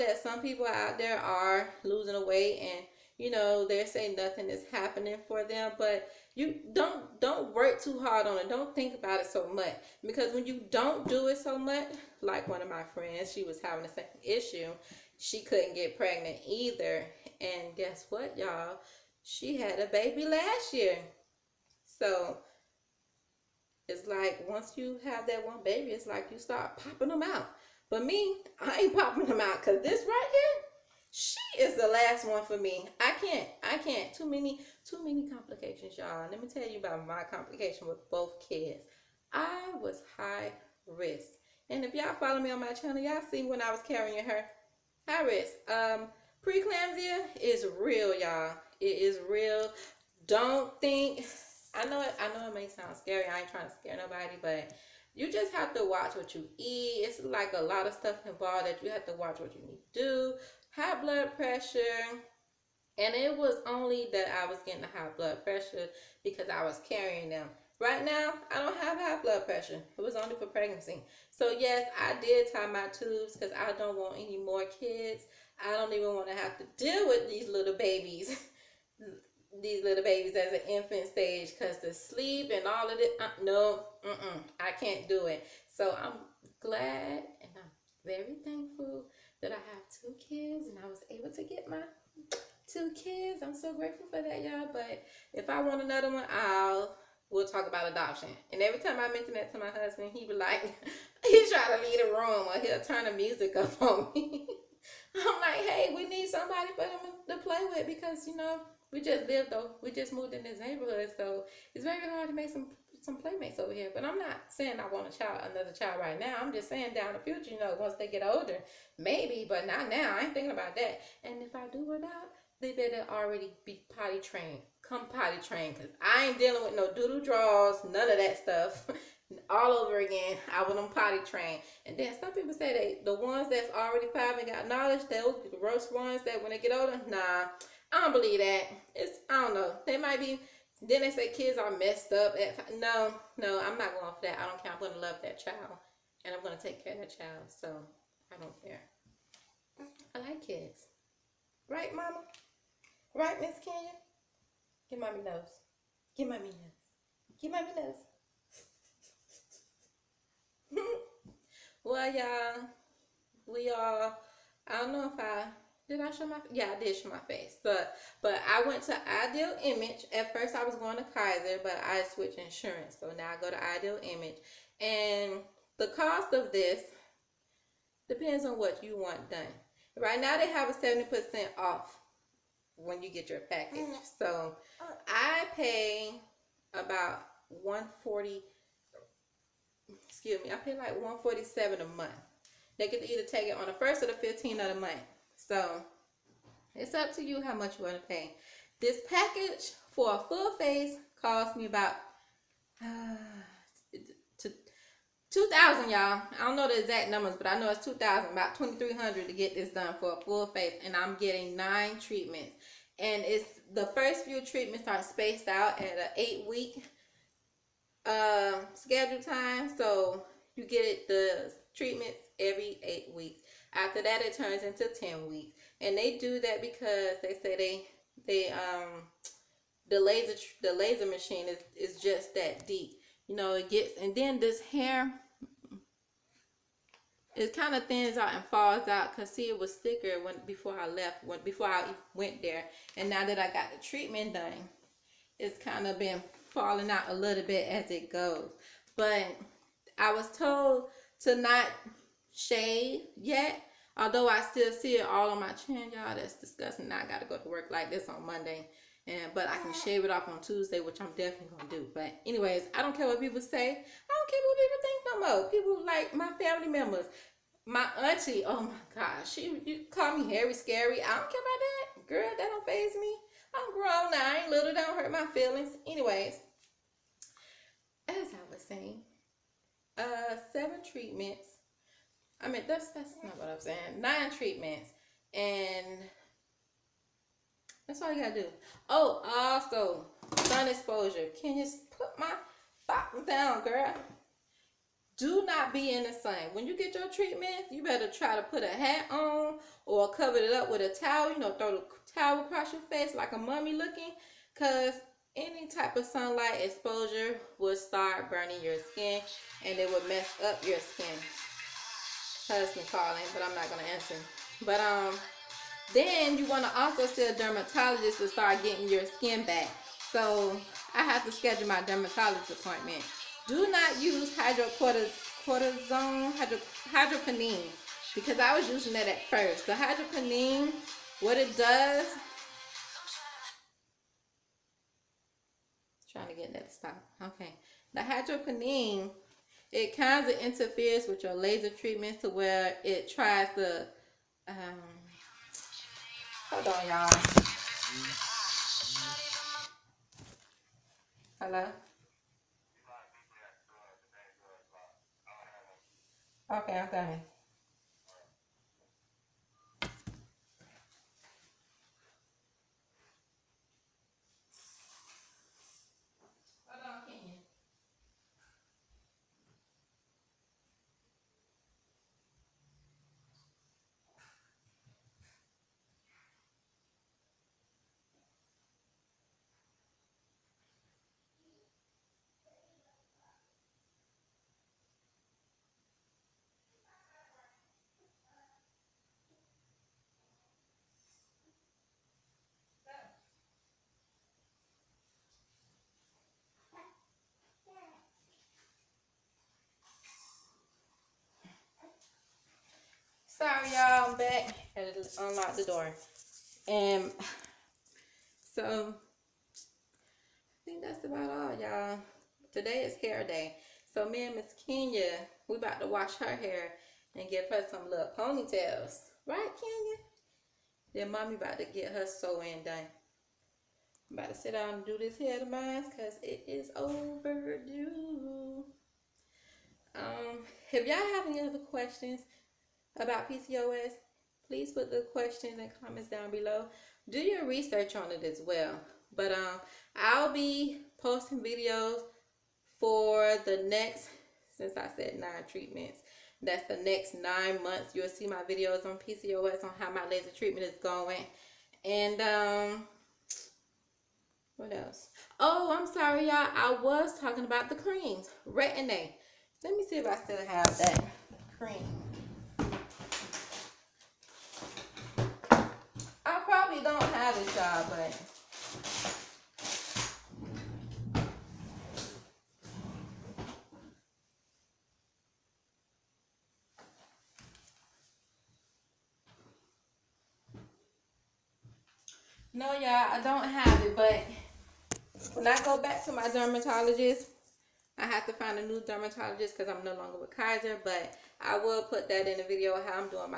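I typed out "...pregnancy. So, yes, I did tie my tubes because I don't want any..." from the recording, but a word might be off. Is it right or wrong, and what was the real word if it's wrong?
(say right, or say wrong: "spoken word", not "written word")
right.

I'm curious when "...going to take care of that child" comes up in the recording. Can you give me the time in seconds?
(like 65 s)
146 s.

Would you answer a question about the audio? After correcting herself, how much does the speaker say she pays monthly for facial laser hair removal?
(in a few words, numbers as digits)
147.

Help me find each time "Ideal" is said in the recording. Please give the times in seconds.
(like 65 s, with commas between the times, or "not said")
169 s, 173 s.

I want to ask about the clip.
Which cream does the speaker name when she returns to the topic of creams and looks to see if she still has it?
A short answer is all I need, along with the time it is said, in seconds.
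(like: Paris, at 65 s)
Retin-A, at 458 s.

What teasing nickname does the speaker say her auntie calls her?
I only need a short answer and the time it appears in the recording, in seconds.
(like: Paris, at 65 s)
Harry Scary, at 270 s.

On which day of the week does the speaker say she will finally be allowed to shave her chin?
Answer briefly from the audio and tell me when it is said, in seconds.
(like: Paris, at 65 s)
Tuesday, at 260 s.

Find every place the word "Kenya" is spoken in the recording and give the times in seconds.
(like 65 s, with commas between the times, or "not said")
153 s, 414 s, 419 s.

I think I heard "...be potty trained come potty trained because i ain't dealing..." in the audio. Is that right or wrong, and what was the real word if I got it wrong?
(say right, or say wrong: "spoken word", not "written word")
right.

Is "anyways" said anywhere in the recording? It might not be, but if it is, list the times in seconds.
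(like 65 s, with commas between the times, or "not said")
262 s, 275 s.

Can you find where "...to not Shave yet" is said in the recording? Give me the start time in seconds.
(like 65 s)
251 s.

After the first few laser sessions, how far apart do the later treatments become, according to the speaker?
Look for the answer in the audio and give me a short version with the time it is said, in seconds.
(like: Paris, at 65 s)
10 weeks, at 224 s.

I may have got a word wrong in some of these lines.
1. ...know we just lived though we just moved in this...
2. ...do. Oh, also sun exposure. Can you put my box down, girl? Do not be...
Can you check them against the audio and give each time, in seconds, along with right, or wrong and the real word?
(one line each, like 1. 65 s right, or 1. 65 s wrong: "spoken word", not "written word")
1. 108 s right
2. 288 s right.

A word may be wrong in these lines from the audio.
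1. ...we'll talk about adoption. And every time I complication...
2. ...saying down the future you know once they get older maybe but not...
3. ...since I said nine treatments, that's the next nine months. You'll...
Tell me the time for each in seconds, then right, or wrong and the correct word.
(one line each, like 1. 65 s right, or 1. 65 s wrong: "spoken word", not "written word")
1. 97 s wrong: "mention", not "complication"
2. 116 s right
3. 444 s right.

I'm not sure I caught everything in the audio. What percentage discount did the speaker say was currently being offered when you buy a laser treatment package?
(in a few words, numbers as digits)
70%.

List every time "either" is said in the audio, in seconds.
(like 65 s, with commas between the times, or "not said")
16 s, 193 s.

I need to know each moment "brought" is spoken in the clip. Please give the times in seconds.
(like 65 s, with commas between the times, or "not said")
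not said.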